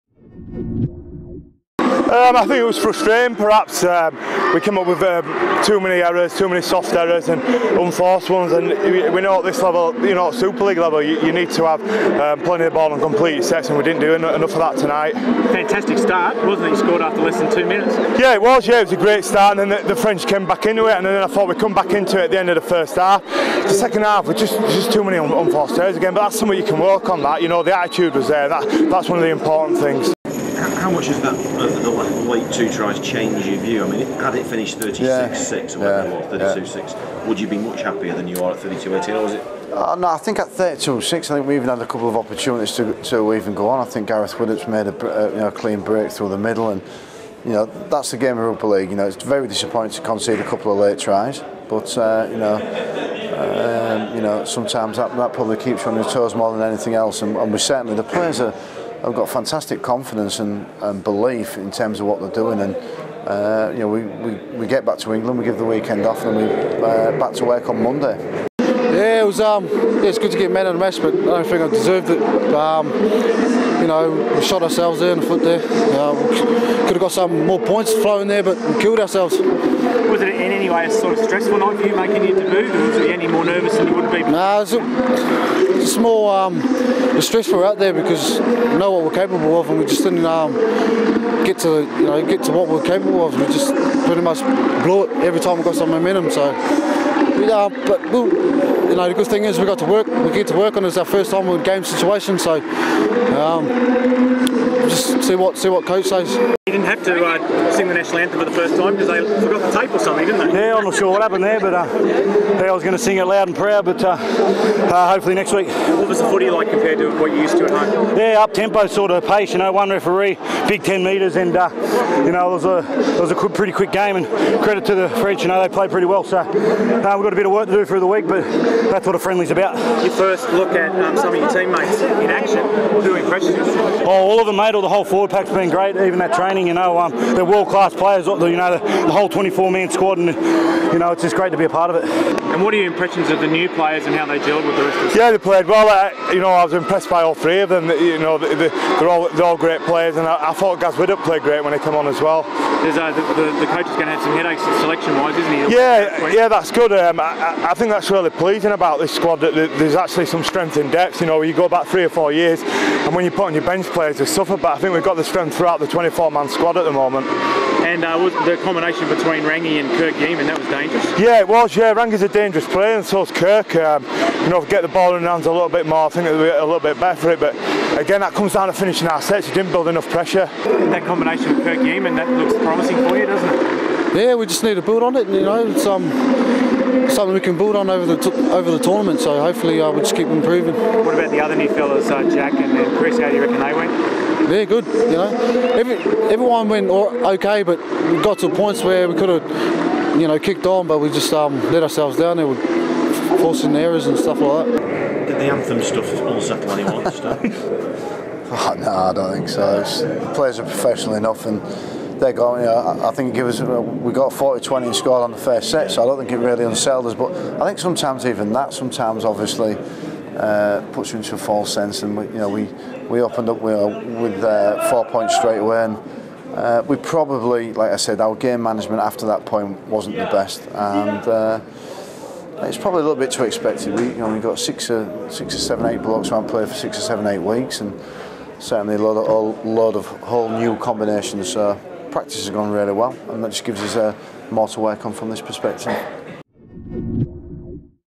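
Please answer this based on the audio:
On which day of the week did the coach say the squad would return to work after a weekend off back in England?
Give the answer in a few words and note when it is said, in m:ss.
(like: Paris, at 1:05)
Monday, at 1:07.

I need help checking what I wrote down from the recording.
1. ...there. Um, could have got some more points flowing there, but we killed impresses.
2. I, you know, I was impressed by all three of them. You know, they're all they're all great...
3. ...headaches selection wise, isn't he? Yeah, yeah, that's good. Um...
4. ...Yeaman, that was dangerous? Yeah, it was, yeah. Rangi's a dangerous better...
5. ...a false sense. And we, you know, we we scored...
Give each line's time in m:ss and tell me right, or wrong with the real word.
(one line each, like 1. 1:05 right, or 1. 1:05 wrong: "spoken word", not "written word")
1. 1:15 wrong: "ourselves", not "impresses"
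2. 2:25 right
3. 2:34 right
4. 2:50 wrong: "player", not "better"
5. 3:41 wrong: "opened", not "scored".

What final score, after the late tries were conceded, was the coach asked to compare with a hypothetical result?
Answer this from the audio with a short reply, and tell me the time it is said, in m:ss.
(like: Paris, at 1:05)
32-18, at 0:38.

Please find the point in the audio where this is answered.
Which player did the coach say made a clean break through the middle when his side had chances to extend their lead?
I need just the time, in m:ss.
0:44.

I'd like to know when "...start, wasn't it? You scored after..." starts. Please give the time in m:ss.
0:15.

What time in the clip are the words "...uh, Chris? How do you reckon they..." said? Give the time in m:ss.
3:12.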